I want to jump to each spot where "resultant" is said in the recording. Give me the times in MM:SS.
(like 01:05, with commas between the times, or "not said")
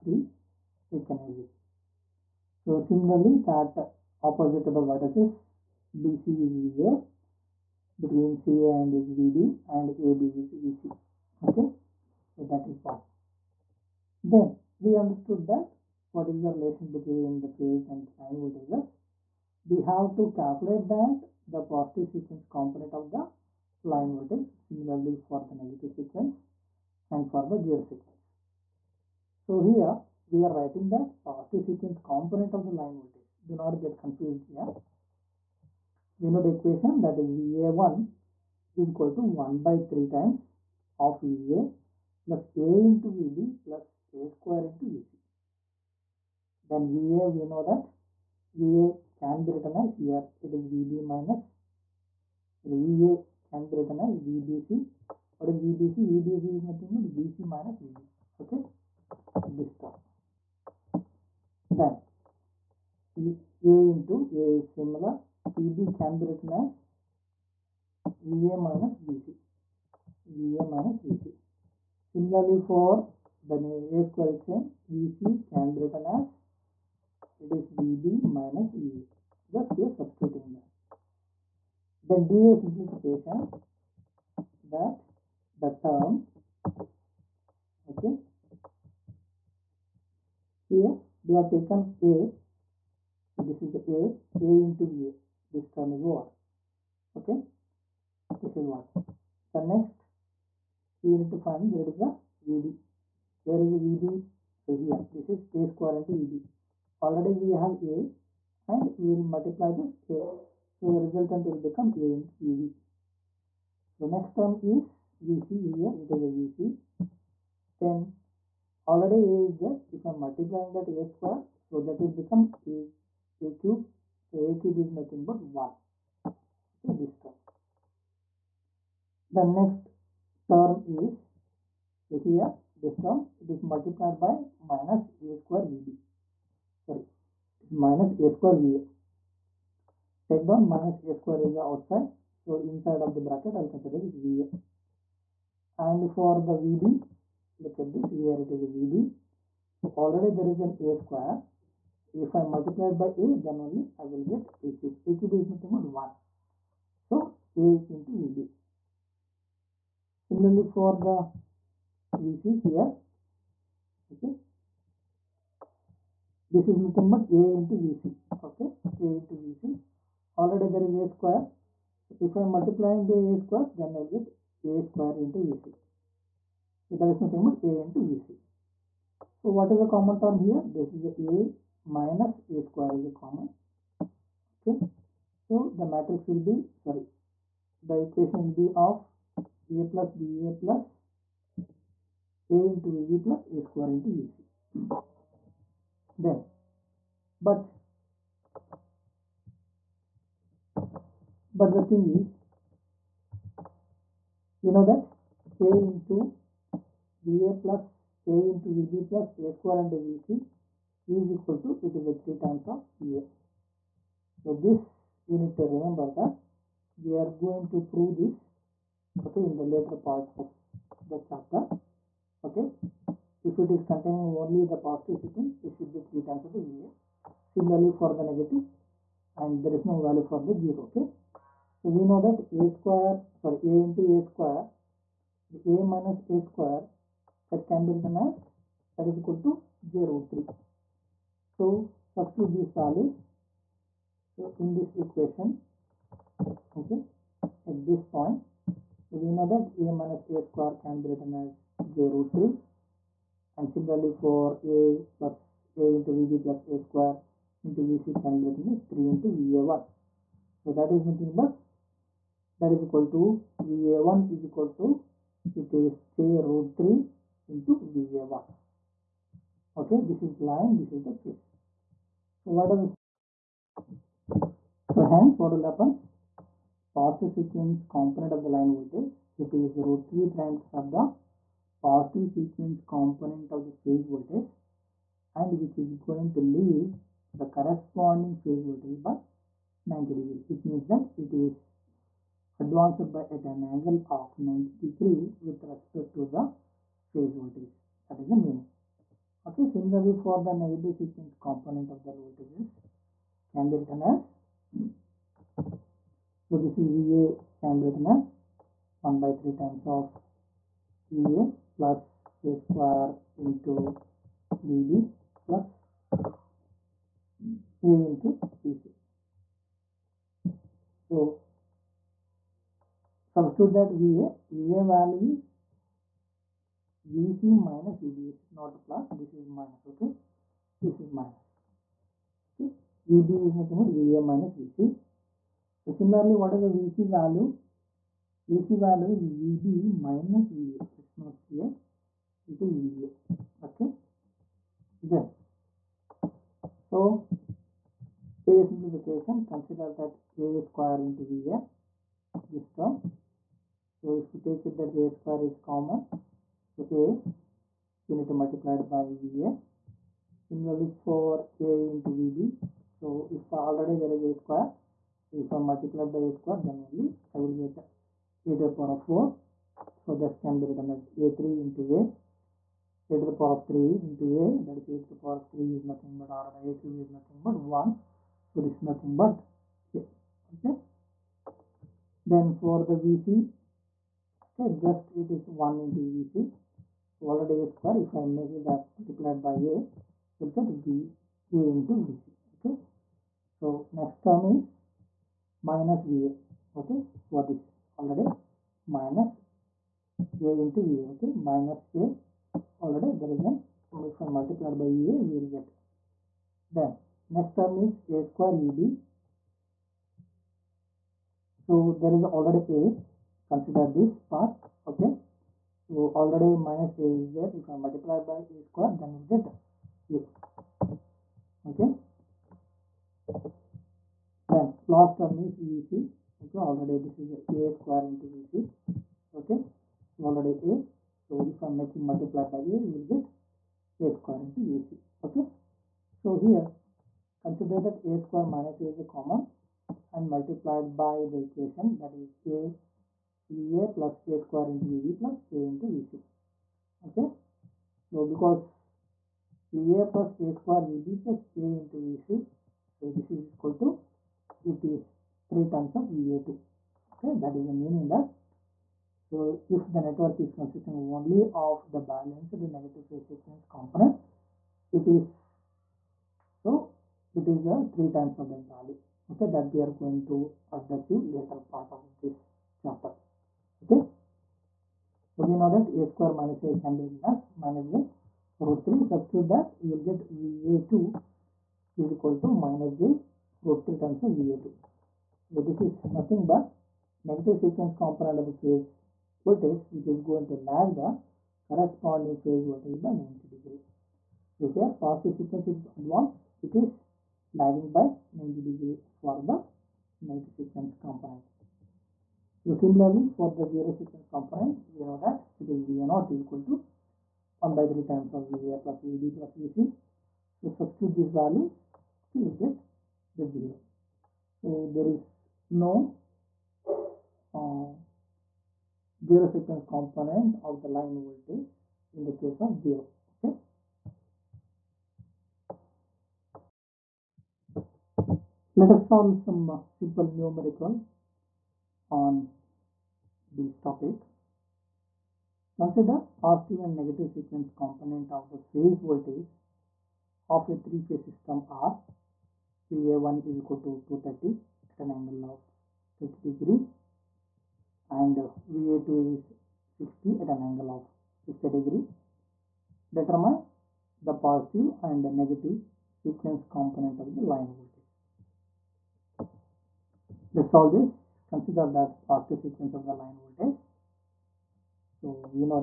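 01:51.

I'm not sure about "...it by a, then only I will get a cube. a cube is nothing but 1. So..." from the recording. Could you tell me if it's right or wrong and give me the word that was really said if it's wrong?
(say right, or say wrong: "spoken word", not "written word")
right.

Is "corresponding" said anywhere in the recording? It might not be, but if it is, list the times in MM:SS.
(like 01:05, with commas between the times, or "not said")
04:47, 08:11.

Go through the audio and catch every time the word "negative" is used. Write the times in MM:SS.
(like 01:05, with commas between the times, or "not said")
00:25, 03:48, 05:00, 07:42, 08:07, 08:20, 08:56, 09:15.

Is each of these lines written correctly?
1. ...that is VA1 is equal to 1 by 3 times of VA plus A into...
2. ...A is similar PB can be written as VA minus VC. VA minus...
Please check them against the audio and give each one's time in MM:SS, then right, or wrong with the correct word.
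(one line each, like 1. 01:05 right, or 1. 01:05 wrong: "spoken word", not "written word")
1. 00:37 right
2. 01:04 right.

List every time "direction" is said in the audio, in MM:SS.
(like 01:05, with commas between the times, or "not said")
not said.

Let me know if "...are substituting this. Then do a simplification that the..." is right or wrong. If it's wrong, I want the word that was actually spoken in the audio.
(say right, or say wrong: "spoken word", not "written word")
right.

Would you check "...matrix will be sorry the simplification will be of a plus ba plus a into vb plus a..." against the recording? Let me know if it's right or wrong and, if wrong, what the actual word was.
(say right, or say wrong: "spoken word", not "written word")
wrong: "equation", not "simplification".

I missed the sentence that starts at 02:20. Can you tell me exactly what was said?
Take down minus a square is outside.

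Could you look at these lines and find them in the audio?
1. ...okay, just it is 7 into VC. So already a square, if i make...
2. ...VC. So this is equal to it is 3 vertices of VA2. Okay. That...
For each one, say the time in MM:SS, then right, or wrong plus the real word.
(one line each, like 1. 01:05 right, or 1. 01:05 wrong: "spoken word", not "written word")
1. 06:24 wrong: "1", not "7"
2. 07:32 wrong: "times", not "vertices".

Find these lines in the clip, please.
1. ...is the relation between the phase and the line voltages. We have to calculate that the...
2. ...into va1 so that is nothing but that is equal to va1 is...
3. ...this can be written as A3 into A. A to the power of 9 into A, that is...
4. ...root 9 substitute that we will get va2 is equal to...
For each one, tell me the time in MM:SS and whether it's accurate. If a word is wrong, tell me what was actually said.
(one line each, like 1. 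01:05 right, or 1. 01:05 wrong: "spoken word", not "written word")
1. 00:16 right
2. 04:19 right
3. 06:10 wrong: "3", not "9"
4. 07:58 wrong: "3", not "9".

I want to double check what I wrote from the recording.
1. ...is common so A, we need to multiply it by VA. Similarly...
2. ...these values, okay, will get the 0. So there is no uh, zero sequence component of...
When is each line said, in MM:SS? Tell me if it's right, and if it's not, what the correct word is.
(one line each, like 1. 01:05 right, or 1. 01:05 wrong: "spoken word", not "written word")
1. 05:55 right
2. 08:31 right.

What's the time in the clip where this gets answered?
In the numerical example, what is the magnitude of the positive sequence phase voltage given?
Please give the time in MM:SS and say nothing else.
09:04.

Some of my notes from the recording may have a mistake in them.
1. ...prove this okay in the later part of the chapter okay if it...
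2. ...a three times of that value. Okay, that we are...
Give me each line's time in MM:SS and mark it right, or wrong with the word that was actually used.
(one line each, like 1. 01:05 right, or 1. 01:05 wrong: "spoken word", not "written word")
1. 03:37 right
2. 07:47 right.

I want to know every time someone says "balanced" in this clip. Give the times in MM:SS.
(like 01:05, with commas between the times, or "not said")
07:41.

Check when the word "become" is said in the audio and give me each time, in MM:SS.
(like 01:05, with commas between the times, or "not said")
01:51, 02:02.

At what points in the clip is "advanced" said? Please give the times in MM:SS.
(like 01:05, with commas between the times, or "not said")
04:52, 08:15.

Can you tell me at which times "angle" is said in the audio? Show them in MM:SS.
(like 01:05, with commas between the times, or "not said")
04:53, 09:05, 09:10.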